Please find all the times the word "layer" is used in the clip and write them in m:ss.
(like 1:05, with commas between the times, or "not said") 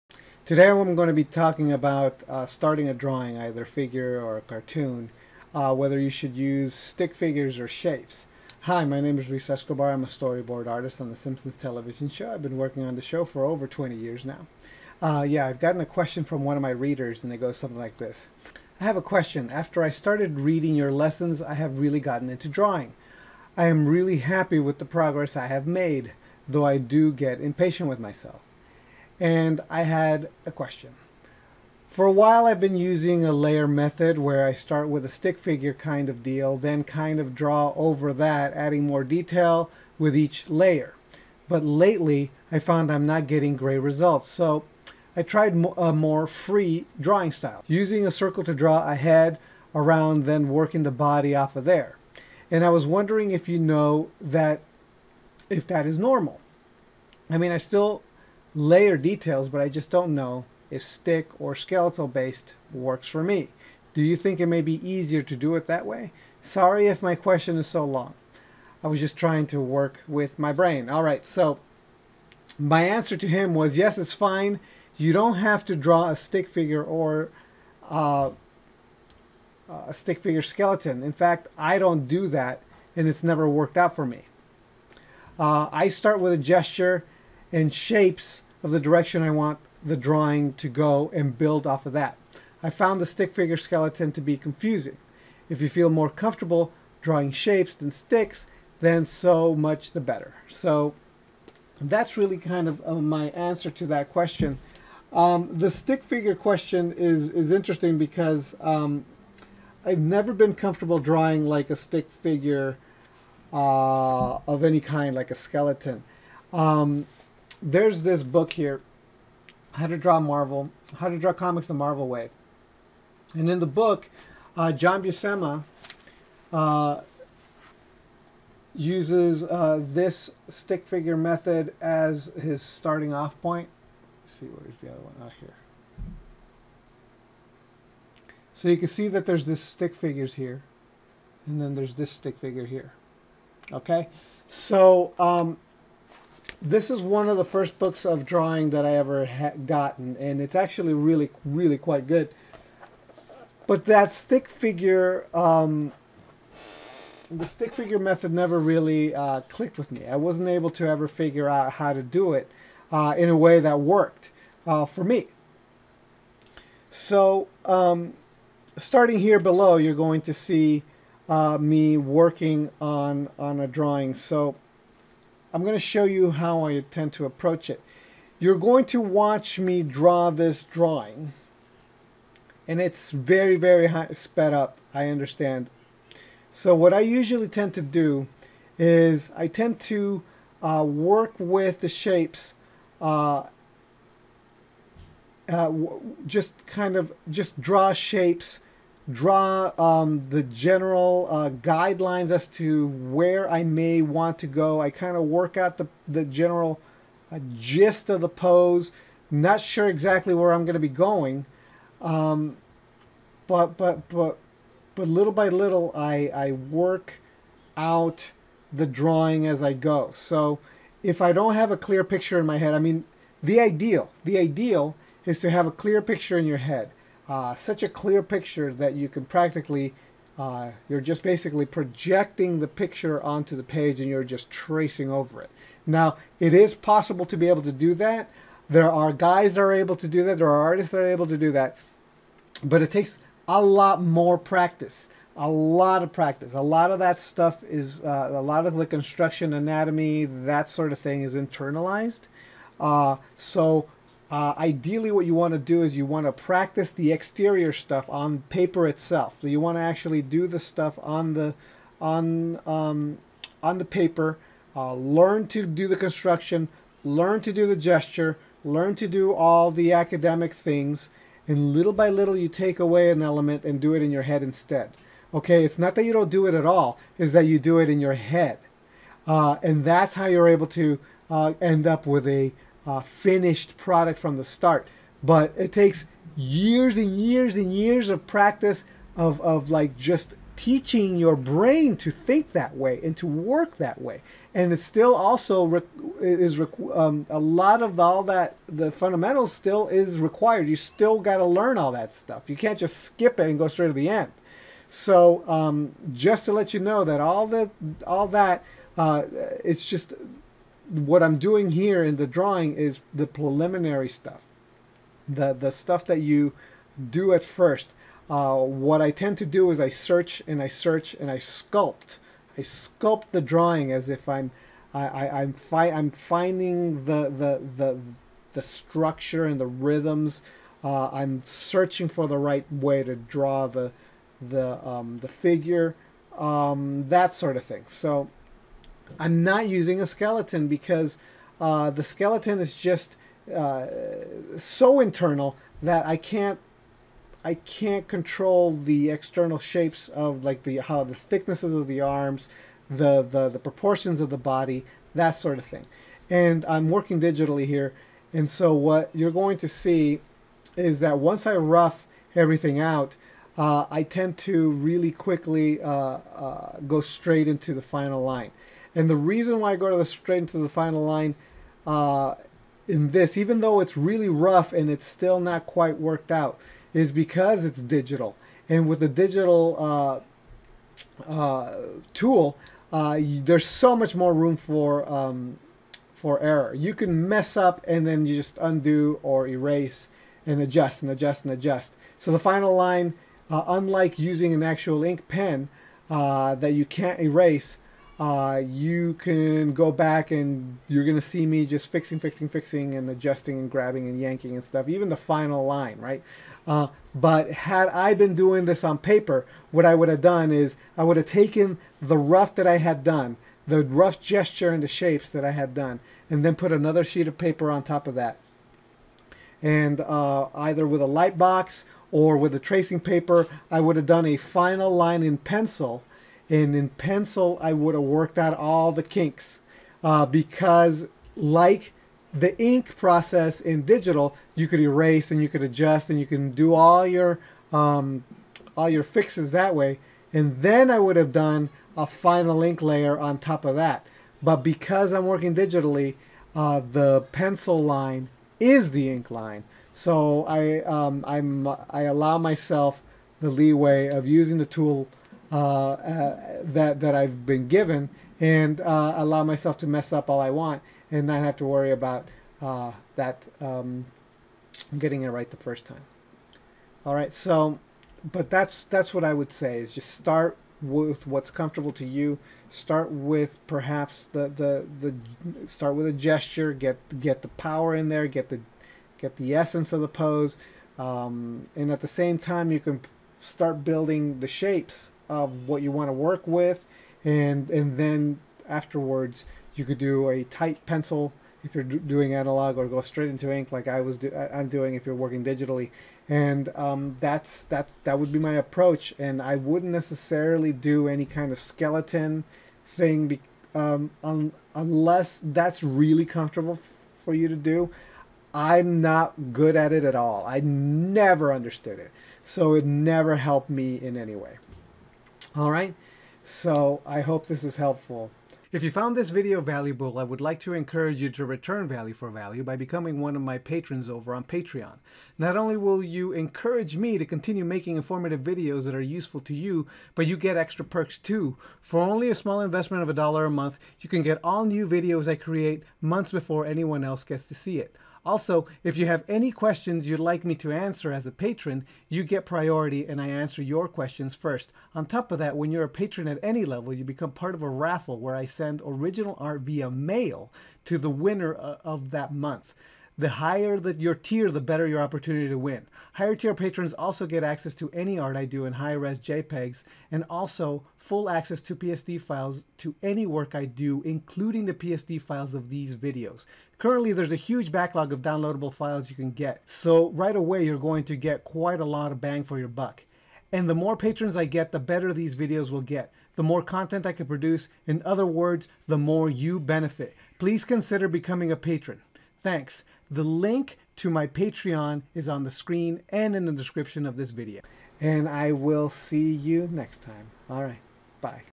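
0:33, 0:40, 0:58, 7:22.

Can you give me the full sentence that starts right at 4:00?
There are artists that are able to do that.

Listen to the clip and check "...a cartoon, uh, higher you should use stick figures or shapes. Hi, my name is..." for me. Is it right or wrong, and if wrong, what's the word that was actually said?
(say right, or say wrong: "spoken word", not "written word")
wrong: "whether", not "higher".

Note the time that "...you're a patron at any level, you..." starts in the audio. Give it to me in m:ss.
9:05.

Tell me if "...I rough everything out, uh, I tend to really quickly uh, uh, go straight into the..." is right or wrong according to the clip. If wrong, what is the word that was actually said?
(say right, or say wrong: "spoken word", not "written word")
right.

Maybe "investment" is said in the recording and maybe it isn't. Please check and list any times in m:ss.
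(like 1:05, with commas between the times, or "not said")
8:52.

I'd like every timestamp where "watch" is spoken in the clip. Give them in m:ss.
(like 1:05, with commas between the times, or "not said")
2:59.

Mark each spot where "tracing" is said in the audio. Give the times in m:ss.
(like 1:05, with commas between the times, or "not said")
3:54, 7:02.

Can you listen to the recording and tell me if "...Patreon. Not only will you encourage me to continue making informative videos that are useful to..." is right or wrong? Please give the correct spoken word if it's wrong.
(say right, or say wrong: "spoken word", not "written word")
right.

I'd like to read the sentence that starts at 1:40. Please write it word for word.
So that's really kind of uh, my answer to that question.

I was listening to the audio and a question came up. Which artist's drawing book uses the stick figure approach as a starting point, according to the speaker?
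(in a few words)
John Buscema.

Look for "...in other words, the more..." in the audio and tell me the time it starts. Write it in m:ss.
9:37.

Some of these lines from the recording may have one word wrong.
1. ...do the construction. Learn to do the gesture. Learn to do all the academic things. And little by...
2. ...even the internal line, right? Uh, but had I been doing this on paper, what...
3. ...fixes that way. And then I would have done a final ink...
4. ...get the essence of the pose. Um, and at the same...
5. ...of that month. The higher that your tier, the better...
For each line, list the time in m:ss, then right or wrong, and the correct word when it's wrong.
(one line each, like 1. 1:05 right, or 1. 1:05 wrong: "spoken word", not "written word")
1. 4:25 right
2. 6:44 wrong: "final", not "internal"
3. 7:19 right
4. 7:59 right
5. 9:11 right.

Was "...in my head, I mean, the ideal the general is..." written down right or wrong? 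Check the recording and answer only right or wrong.
wrong.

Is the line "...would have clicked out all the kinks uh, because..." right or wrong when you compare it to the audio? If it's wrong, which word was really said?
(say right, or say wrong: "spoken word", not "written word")
wrong: "worked", not "clicked".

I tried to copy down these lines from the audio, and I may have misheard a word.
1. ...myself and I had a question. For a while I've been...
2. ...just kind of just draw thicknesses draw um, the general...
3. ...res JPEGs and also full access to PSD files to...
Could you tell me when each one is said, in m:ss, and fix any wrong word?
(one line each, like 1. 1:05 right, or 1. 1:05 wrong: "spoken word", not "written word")
1. 0:28 right
2. 3:16 wrong: "shapes", not "thicknesses"
3. 9:18 right.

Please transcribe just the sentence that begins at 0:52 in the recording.
And I was wondering if you know that, if that is normal.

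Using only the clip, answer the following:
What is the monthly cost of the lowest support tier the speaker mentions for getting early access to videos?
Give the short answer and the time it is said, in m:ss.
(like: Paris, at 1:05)
a dollar, at 8:53.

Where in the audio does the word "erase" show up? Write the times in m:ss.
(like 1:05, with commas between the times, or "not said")
6:29, 6:37, 7:14.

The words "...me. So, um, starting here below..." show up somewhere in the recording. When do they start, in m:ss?
2:45.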